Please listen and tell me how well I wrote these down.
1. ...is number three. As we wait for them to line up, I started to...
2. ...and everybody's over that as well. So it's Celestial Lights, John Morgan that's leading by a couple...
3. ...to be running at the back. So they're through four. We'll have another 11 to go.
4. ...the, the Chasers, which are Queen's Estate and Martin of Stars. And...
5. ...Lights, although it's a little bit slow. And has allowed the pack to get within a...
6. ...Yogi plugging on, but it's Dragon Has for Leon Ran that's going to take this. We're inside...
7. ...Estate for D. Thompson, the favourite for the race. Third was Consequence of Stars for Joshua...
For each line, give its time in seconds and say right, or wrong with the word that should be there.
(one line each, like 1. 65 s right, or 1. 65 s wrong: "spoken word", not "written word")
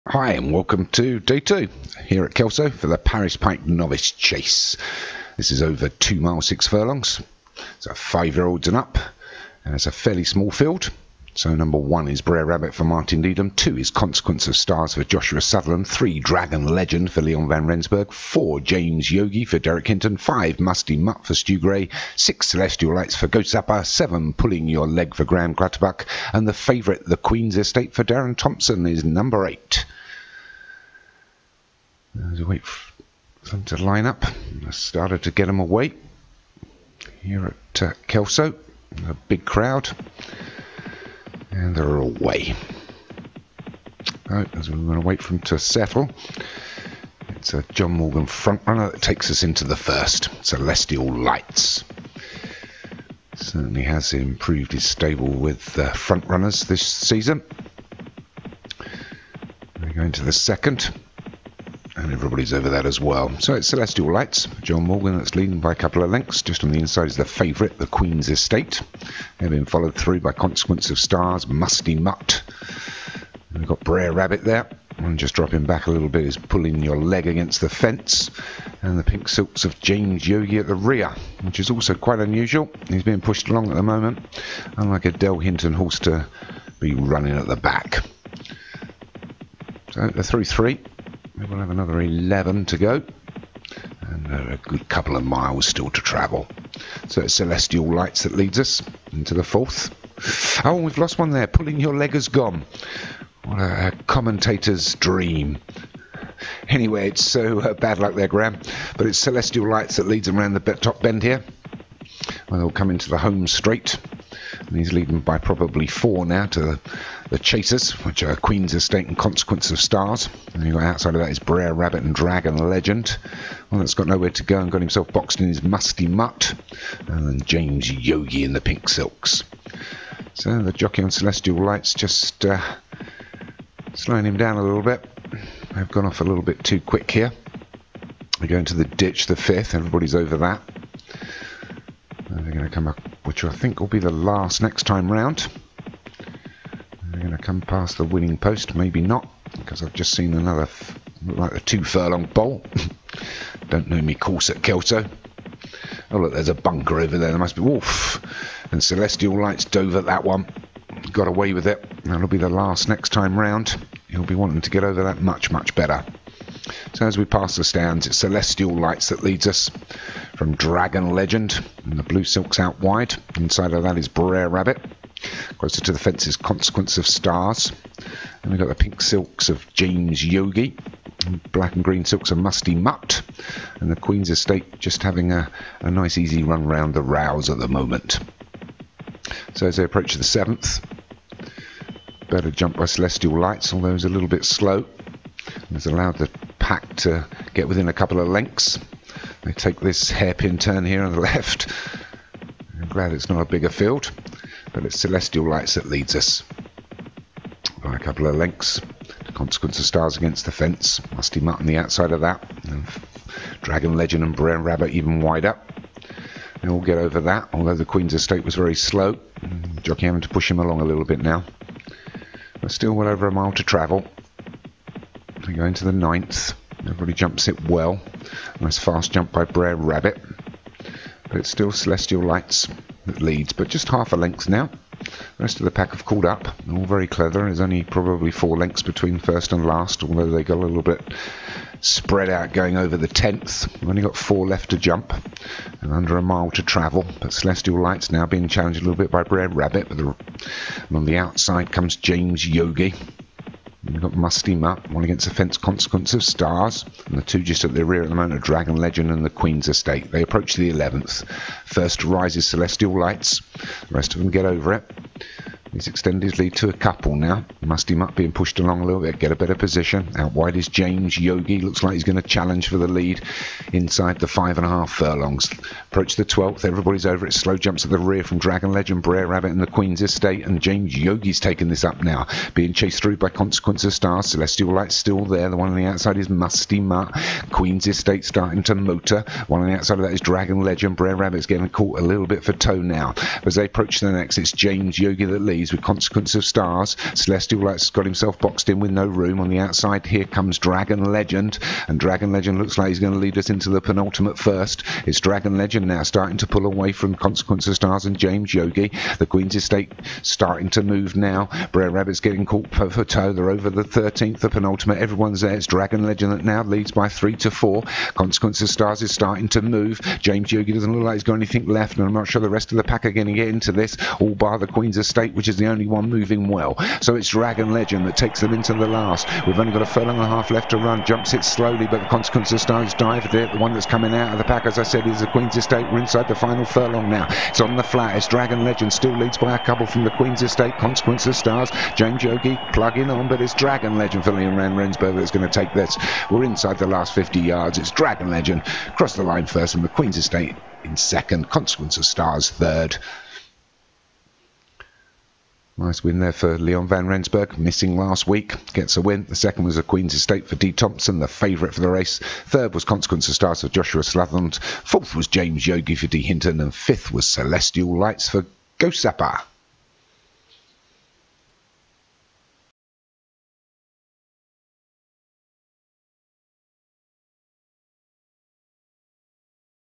1. 28 s wrong: "eight", not "three"
2. 62 s right
3. 85 s wrong: "three", not "four"
4. 116 s wrong: "Consequence", not "Martin"
5. 193 s right
6. 342 s wrong: "Legend", not "Has"
7. 360 s right.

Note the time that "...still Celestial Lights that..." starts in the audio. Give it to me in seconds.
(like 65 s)
231 s.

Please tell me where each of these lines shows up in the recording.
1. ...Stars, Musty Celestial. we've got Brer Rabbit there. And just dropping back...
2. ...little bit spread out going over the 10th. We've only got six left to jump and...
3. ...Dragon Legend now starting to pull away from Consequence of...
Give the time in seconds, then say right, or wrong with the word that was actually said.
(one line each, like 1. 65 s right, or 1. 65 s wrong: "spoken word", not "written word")
1. 70 s wrong: "Mutt", not "Celestial"
2. 240 s wrong: "four", not "six"
3. 305 s right.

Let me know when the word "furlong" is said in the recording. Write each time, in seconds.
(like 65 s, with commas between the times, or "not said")
6 s, 151 s, 274 s, 329 s, 336 s.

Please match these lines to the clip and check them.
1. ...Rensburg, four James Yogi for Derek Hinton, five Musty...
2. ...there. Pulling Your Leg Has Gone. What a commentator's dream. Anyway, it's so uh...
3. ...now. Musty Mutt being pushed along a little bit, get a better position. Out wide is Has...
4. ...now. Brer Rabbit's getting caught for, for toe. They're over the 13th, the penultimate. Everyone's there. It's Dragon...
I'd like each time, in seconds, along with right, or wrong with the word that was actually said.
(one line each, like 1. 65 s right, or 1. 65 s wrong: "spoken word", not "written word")
1. 17 s right
2. 101 s right
3. 267 s wrong: "James", not "Has"
4. 311 s right.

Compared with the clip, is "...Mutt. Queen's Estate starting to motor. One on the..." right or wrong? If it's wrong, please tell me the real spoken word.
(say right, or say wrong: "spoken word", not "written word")
right.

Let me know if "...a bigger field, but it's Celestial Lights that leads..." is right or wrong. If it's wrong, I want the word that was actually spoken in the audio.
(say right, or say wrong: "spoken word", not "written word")
right.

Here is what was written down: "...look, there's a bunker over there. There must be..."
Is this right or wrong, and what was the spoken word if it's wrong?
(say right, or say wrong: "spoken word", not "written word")
right.